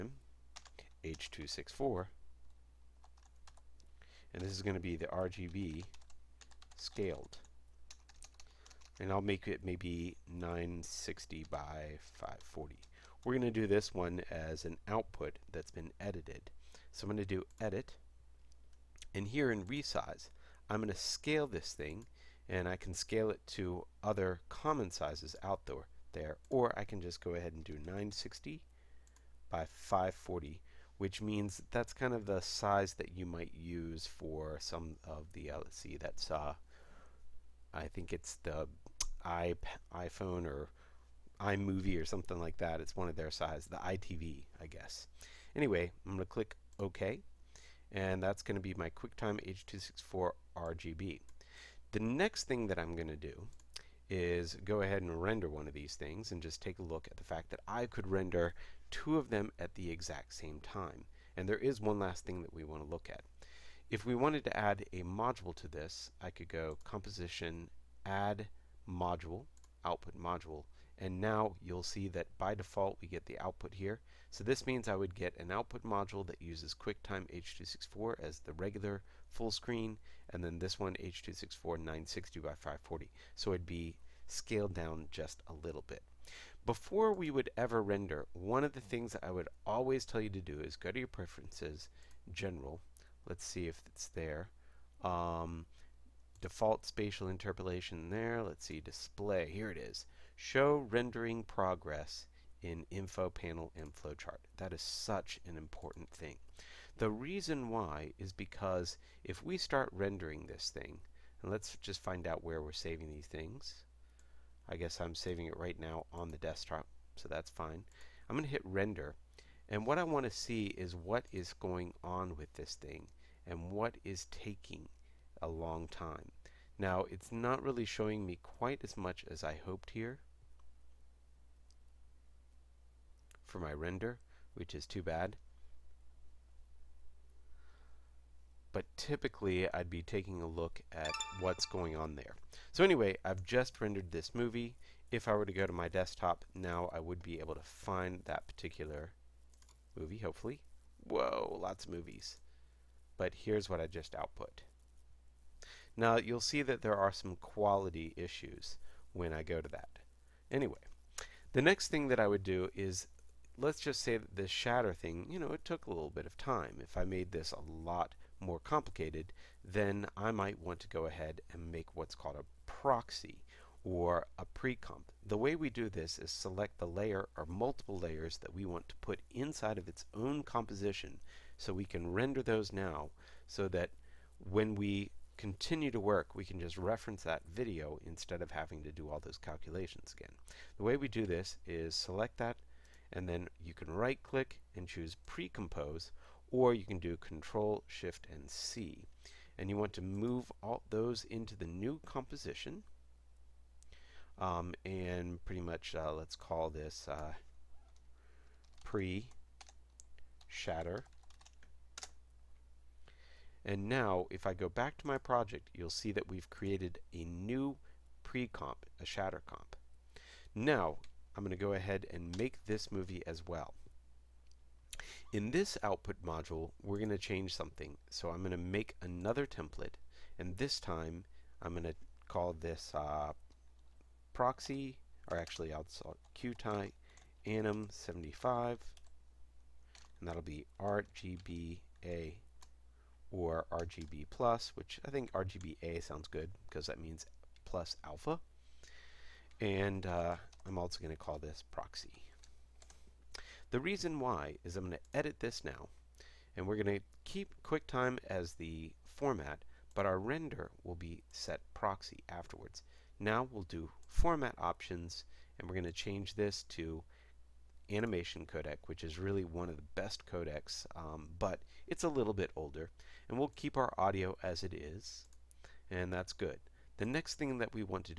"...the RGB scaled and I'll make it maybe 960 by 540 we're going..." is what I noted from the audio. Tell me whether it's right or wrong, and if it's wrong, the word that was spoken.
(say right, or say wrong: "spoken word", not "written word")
right.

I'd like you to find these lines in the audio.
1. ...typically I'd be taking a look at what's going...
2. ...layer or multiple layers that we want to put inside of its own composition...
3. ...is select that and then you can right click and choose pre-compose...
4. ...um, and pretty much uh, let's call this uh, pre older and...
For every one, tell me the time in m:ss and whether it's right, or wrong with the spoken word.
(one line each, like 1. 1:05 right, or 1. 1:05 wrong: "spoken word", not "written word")
1. 2:18 right
2. 2:56 right
3. 3:11 right
4. 3:24 wrong: "shatter", not "older".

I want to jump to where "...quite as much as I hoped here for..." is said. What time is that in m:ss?
2:08.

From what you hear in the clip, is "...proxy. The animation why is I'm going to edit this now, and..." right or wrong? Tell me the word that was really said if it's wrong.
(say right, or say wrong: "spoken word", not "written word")
wrong: "reason", not "animation".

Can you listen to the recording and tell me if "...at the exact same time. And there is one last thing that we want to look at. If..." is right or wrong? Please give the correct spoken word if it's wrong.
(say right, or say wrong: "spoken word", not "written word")
right.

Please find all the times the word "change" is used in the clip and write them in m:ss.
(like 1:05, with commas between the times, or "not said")
3:47, 4:25.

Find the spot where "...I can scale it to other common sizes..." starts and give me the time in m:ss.
0:22.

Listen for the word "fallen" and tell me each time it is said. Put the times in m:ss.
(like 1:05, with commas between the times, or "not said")
not said.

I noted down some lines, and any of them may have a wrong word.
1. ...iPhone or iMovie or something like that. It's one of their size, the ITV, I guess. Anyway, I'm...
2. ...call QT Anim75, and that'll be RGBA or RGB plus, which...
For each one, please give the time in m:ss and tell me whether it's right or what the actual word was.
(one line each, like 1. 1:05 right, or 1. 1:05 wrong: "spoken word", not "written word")
1. 0:39 right
2. 3:56 right.